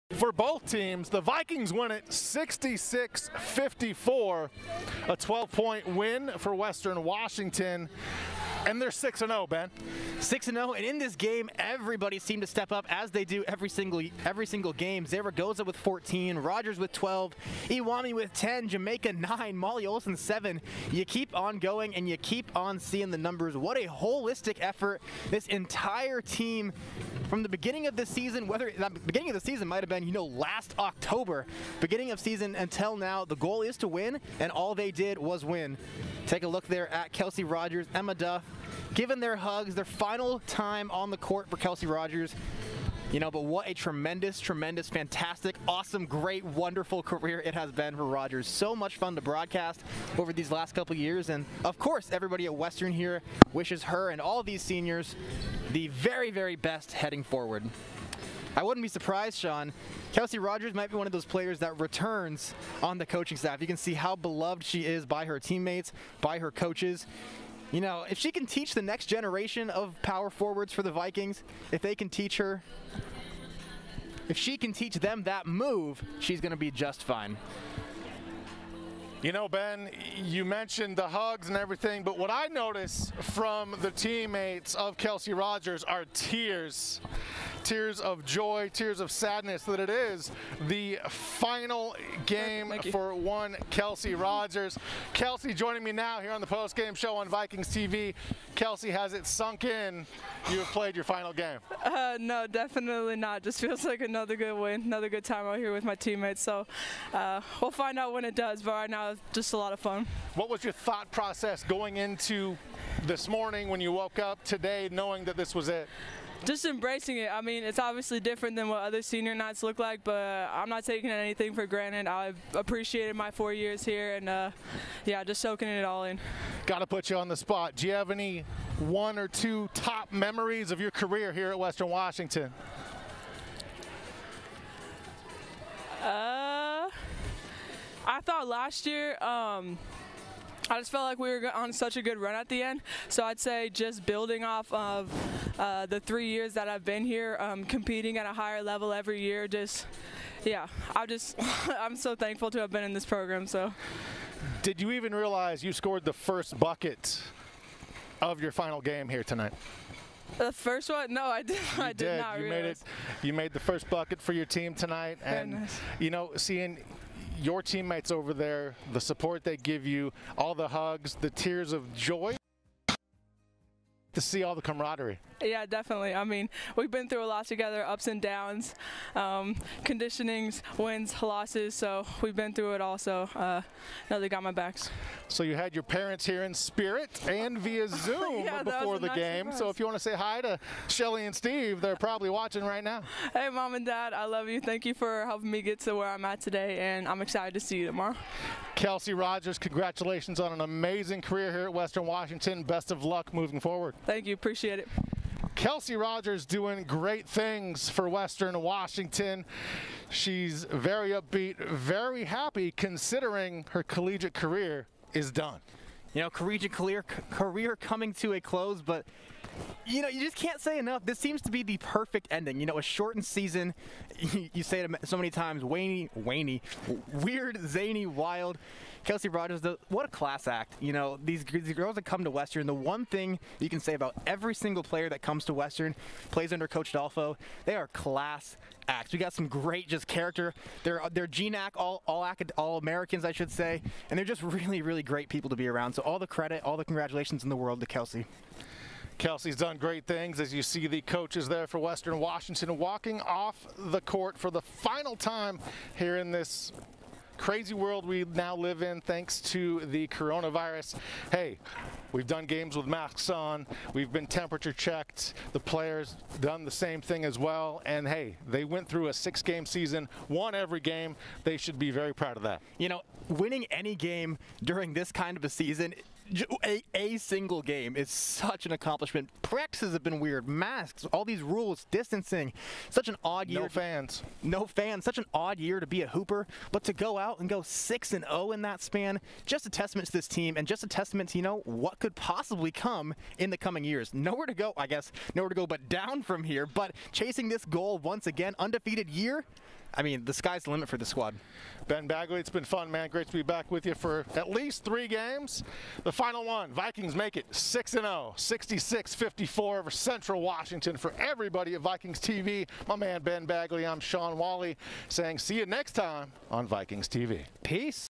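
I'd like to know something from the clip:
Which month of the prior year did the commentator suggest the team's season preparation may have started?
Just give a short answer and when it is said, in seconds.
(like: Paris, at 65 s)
October, at 30 s.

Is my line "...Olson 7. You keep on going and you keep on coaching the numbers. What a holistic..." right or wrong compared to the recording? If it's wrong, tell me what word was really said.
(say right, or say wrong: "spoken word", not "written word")
wrong: "seeing", not "coaching".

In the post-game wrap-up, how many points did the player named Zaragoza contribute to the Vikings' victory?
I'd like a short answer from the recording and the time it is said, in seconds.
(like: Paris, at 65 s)
14, at 15 s.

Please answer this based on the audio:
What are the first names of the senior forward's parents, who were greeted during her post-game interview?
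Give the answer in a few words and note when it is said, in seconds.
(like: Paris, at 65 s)
Shelly and Steve, at 190 s.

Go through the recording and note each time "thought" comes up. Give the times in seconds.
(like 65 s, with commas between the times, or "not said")
110 s, 138 s.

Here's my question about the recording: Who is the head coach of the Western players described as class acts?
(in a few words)
Coach Dolfo.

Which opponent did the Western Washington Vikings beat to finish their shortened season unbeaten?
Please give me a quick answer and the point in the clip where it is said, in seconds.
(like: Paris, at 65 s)
Central Washington, at 309 s.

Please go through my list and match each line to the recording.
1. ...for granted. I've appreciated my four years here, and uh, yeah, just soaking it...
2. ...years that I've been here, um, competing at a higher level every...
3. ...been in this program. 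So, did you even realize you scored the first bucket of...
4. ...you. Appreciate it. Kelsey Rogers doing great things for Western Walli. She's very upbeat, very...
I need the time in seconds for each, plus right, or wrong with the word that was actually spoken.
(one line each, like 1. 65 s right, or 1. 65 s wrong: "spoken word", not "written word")
1. 121 s right
2. 146 s right
3. 152 s right
4. 204 s wrong: "Washington", not "Walli".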